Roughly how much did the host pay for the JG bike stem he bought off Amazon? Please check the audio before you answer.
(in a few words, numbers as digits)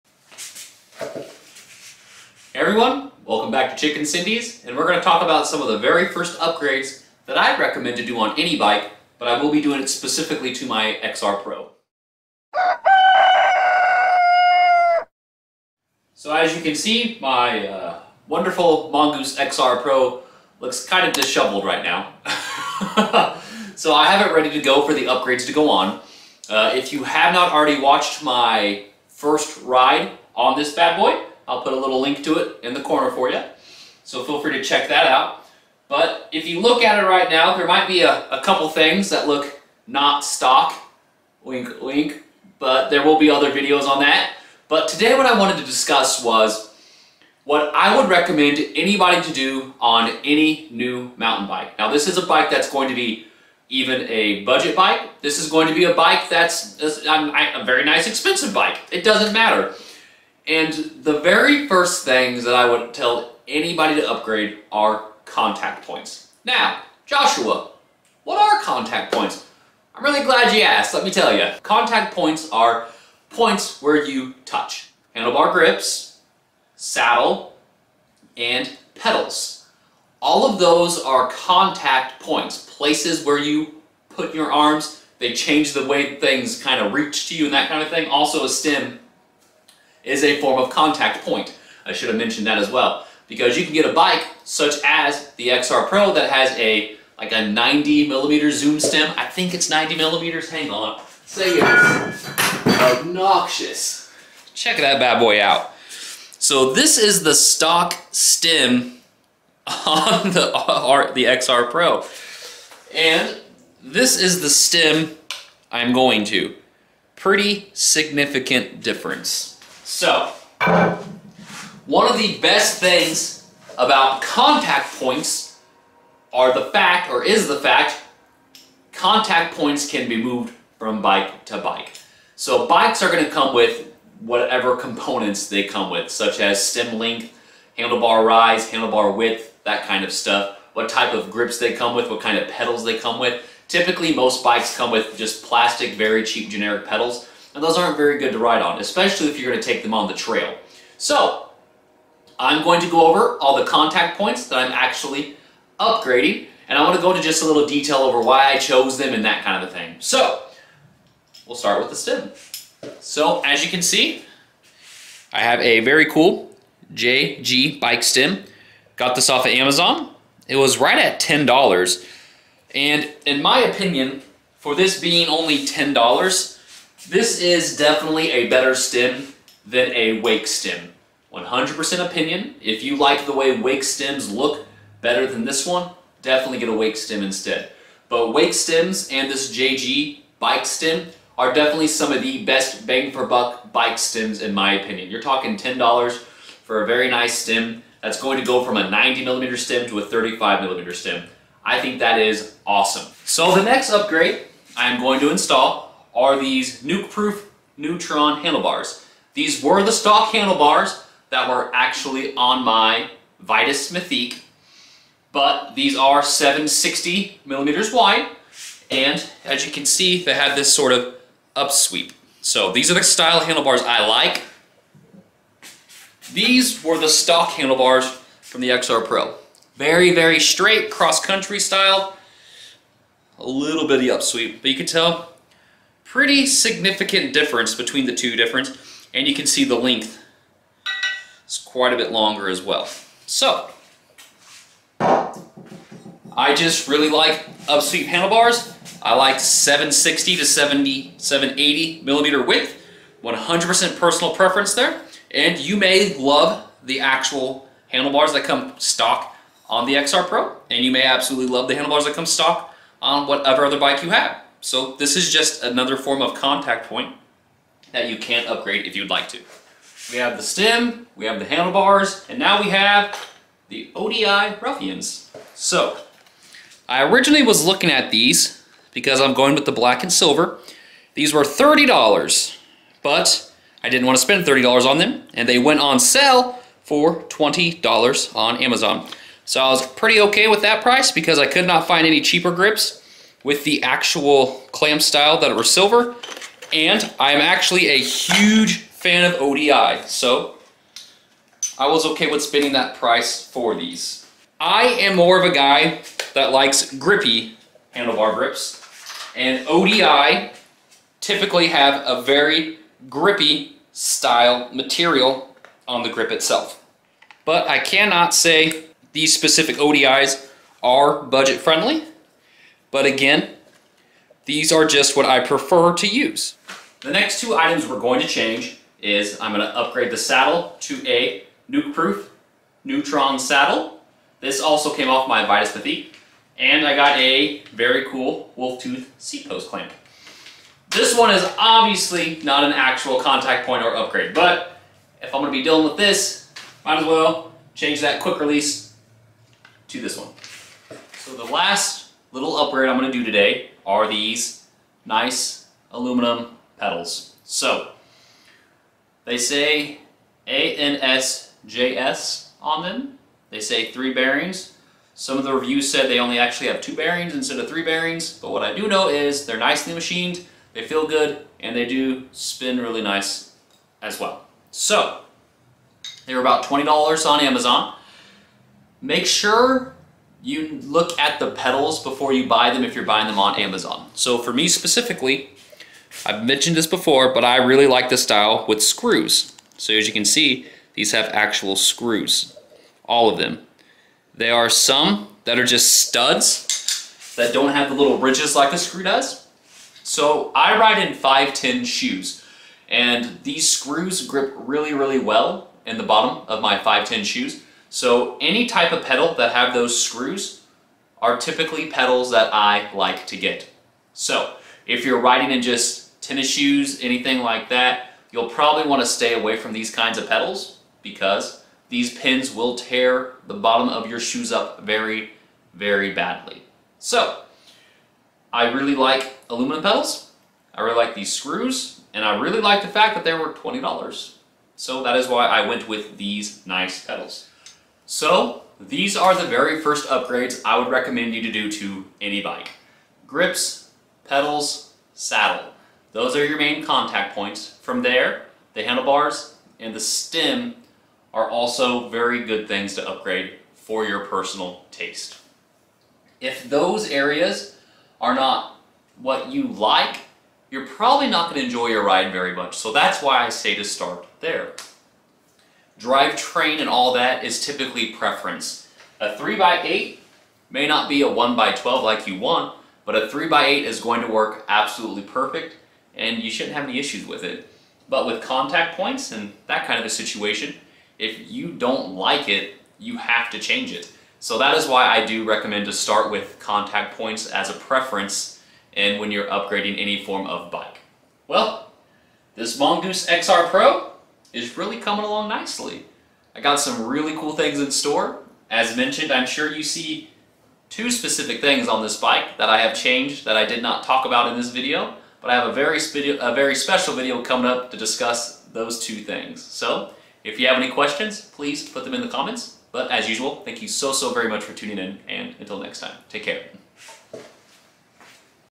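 $10.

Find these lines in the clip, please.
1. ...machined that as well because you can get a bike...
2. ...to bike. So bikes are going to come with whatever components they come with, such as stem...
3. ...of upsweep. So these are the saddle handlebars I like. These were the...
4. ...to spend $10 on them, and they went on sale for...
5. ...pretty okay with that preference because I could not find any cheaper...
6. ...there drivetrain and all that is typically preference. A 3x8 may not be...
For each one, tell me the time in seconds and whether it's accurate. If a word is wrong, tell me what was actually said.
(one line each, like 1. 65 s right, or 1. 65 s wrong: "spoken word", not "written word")
1. 92 s wrong: "mentioned", not "machined"
2. 131 s right
3. 220 s wrong: "style", not "saddle"
4. 284 s wrong: "30", not "10"
5. 289 s wrong: "price", not "preference"
6. 464 s right.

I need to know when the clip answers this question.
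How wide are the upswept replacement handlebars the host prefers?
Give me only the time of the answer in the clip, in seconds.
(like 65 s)
216 s.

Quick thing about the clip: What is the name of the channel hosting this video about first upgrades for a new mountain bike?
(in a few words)
Chicken Sendies.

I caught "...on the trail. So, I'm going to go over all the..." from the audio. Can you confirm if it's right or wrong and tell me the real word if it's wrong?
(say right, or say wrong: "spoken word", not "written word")
right.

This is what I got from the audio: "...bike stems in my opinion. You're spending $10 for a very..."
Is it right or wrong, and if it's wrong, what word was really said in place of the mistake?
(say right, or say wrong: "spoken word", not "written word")
wrong: "talking", not "spending".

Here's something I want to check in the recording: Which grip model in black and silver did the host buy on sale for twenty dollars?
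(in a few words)
ODI Ruffians.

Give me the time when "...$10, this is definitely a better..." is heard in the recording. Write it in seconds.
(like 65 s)
175 s.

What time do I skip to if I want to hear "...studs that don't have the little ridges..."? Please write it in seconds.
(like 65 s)
396 s.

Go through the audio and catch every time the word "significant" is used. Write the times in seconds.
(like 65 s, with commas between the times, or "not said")
117 s, 236 s.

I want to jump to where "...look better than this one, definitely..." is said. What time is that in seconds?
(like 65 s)
184 s.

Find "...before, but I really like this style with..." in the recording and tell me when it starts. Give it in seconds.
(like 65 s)
386 s.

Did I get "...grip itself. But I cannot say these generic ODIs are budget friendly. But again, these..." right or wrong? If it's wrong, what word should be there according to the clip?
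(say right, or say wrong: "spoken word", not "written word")
wrong: "specific", not "generic".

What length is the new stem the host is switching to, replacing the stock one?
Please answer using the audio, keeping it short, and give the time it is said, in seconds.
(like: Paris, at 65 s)
35 millimeters, at 200 s.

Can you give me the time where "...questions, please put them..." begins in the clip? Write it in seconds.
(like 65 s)
510 s.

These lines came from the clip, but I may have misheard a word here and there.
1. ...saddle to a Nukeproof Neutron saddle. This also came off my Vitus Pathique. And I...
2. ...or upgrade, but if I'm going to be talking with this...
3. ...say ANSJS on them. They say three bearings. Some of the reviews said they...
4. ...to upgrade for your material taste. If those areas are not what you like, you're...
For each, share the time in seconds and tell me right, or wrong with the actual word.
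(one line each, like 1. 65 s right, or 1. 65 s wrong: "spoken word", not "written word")
1. 330 s right
2. 343 s wrong: "dealing", not "talking"
3. 359 s right
4. 452 s wrong: "personal", not "material".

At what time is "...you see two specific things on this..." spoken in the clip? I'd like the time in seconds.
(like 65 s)
499 s.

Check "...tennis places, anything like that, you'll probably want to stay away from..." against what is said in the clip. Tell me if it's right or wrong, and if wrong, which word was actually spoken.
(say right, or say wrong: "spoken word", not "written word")
wrong: "shoes", not "places".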